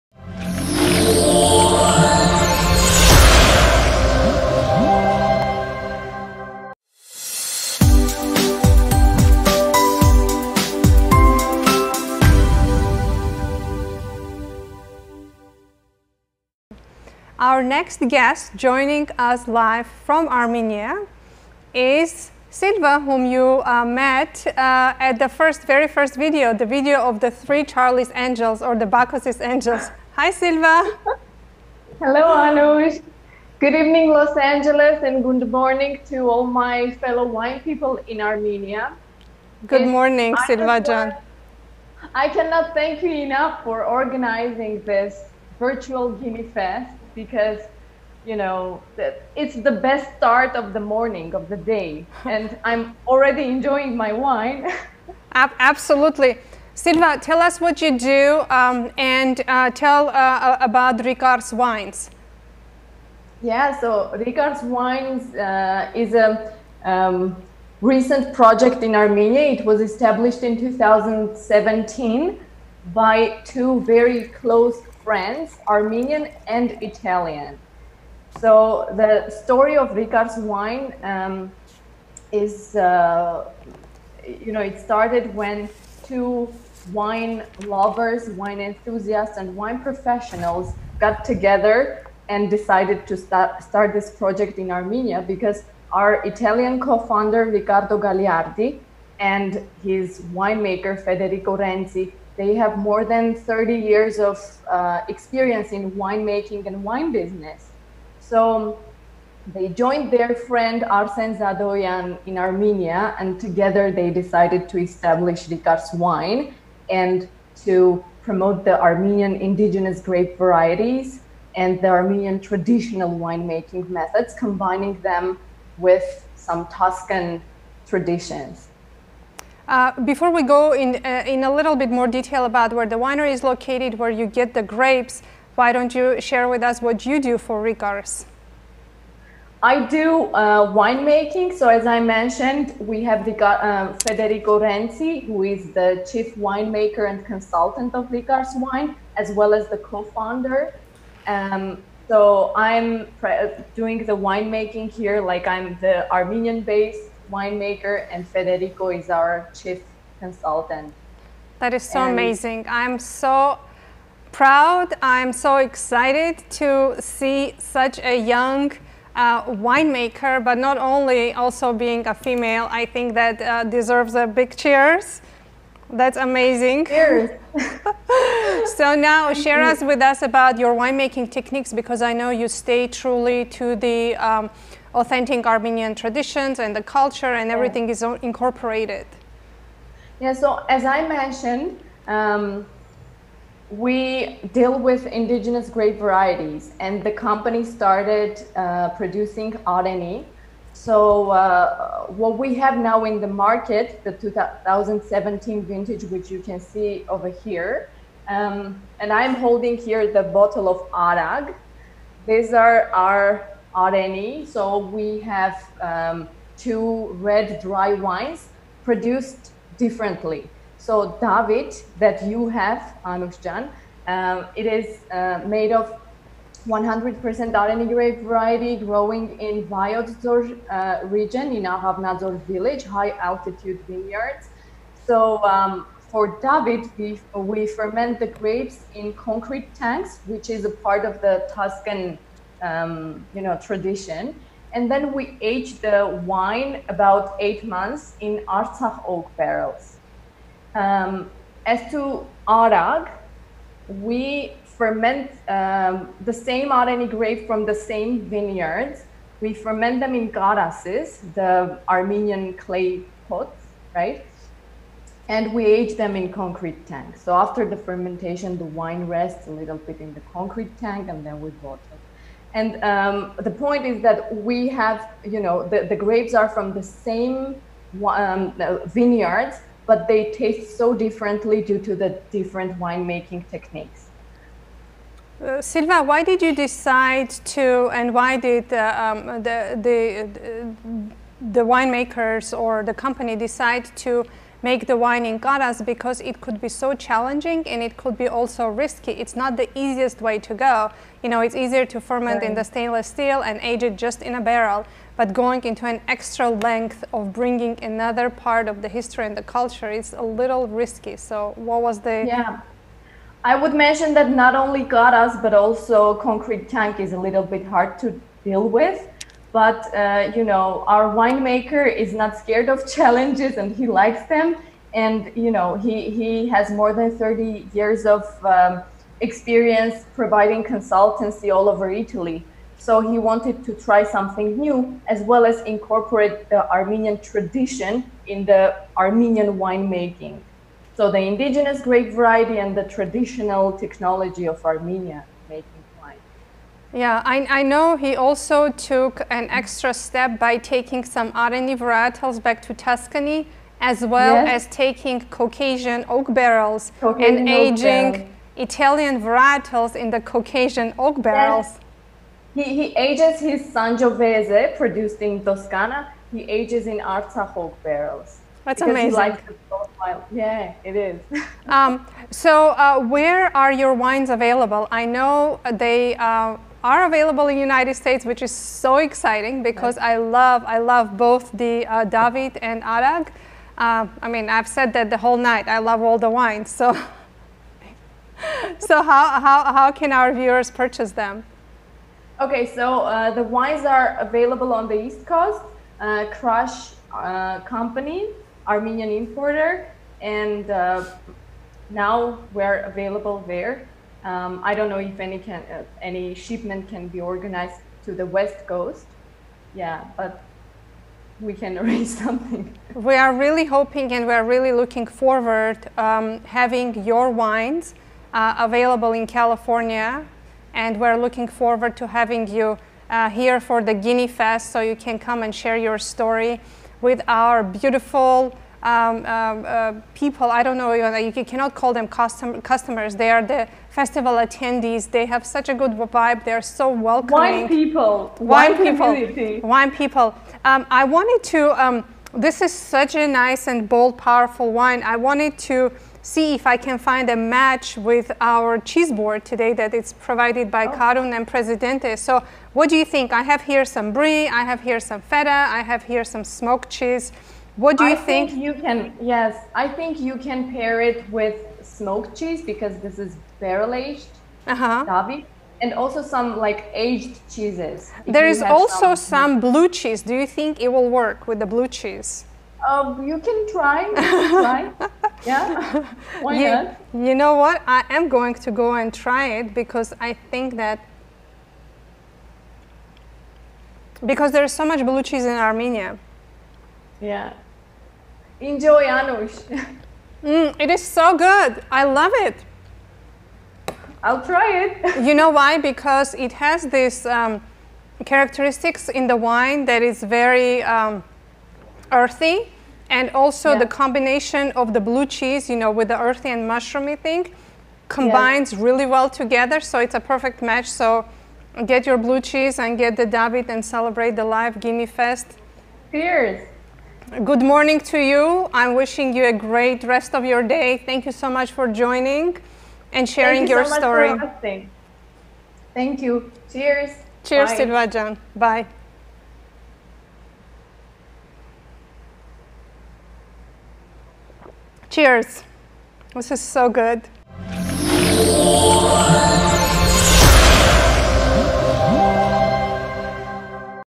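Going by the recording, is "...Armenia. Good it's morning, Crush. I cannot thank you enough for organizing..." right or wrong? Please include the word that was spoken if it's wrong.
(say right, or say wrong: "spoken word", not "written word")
wrong: "Silvajan", not "Crush".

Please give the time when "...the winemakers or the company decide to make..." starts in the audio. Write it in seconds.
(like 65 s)
291 s.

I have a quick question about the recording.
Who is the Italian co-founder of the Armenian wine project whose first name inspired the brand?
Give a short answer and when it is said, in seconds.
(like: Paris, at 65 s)
Riccardo Gagliardi, at 97 s.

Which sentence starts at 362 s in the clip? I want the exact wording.
He, he ages his Sangiovese produced in Toscana.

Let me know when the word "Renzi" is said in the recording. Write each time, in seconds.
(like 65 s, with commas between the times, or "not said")
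101 s, 144 s.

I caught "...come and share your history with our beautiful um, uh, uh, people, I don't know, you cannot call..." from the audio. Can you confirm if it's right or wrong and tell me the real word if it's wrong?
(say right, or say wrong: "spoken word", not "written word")
wrong: "story", not "history".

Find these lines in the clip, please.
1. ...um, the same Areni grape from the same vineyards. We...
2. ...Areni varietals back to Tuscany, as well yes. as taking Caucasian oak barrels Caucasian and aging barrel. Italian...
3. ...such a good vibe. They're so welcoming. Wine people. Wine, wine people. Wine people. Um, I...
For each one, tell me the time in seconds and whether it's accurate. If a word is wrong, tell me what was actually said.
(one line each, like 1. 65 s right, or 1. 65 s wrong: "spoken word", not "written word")
1. 255 s right
2. 351 s right
3. 435 s right.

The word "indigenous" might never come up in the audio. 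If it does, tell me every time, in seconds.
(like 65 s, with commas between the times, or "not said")
119 s, 195 s, 341 s.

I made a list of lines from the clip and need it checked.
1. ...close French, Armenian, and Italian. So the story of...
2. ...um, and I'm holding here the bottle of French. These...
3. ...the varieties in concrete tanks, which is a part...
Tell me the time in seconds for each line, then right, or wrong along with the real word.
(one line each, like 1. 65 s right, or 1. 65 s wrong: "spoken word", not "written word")
1. 74 s right
2. 208 s wrong: "Arag", not "French"
3. 238 s wrong: "grapes", not "varieties".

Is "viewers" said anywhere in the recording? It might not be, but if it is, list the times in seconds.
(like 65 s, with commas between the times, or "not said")
390 s.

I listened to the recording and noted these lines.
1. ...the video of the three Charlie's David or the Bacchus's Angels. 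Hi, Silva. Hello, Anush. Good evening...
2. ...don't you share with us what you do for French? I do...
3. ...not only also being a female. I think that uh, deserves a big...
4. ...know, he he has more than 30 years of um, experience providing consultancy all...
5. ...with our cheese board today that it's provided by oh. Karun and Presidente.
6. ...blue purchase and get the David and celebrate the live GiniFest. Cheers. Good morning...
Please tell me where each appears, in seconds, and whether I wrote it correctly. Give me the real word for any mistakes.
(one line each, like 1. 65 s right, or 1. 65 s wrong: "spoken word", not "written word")
1. 26 s wrong: "Angels", not "David"
2. 135 s wrong: "Rikars", not "French"
3. 170 s right
4. 325 s right
5. 447 s right
6. 512 s wrong: "cheese", not "purchase".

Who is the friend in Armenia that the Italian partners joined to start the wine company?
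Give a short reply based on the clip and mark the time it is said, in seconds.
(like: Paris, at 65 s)
Arsen Zadoyan, at 110 s.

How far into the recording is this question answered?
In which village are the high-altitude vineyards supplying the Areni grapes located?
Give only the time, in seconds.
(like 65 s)
231 s.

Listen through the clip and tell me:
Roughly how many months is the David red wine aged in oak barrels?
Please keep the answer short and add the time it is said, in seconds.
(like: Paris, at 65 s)
8 months, at 247 s.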